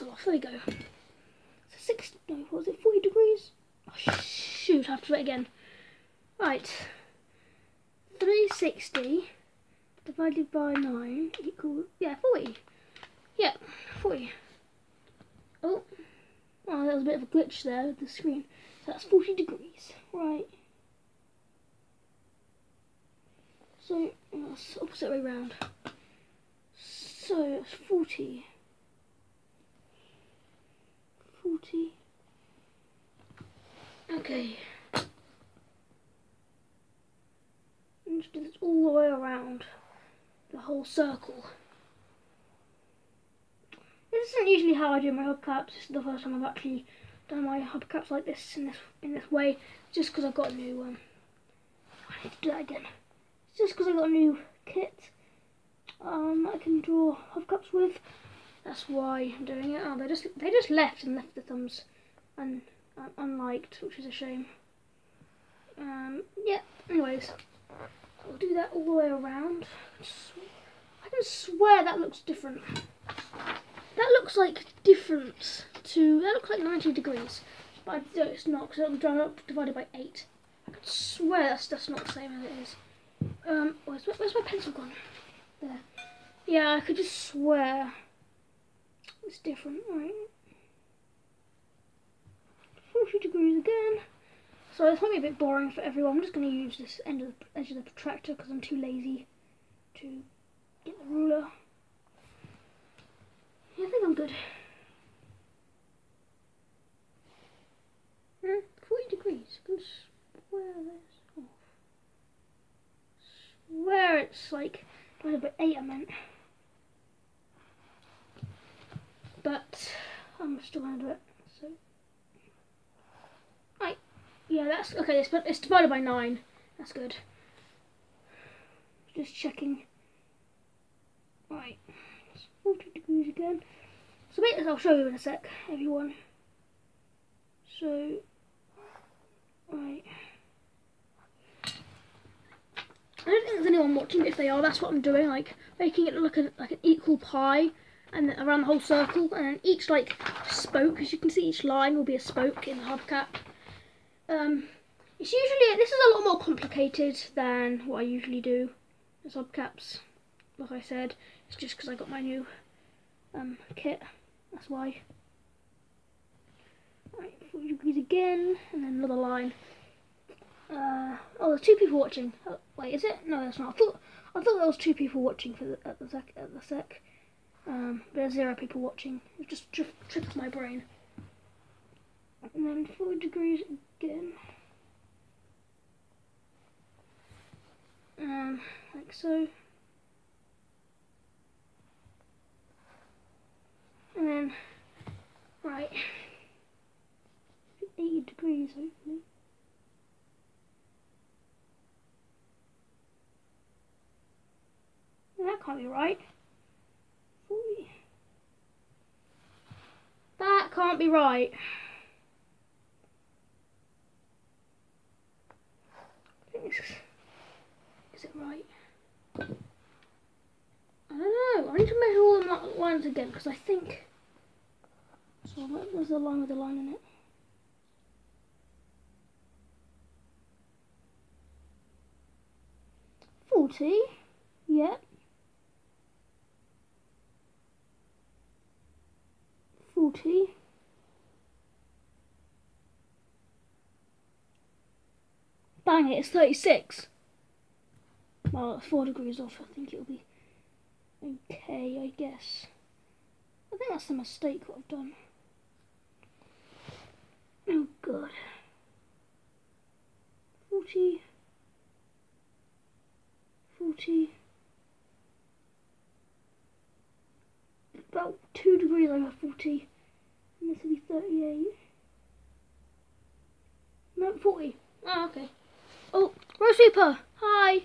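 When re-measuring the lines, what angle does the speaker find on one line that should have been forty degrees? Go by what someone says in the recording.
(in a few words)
36.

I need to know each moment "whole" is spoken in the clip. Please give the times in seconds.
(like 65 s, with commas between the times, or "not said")
40 s, 148 s.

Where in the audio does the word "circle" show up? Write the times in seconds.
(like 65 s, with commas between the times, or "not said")
40 s, 148 s.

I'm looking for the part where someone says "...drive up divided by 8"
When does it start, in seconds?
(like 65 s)
78 s.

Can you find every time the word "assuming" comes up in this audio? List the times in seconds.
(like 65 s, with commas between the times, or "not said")
not said.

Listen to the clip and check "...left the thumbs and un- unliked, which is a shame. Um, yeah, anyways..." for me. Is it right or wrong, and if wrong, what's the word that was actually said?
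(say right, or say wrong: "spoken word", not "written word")
right.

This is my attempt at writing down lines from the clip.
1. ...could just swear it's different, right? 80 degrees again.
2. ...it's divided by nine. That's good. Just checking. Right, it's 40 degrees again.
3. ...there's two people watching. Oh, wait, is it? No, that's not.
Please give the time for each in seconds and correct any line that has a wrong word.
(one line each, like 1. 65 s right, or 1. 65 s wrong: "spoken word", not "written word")
1. 86 s wrong: "40", not "80"
2. 125 s right
3. 171 s right.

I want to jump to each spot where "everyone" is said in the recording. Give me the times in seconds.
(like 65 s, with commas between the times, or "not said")
95 s, 135 s.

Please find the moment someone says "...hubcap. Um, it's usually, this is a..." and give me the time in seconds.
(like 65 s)
152 s.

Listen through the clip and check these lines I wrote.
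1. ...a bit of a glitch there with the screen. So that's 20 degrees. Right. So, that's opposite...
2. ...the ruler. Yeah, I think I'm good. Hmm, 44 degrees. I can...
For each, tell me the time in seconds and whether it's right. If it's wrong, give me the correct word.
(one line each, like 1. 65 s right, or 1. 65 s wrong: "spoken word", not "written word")
1. 17 s wrong: "40", not "20"
2. 101 s wrong: "40", not "44".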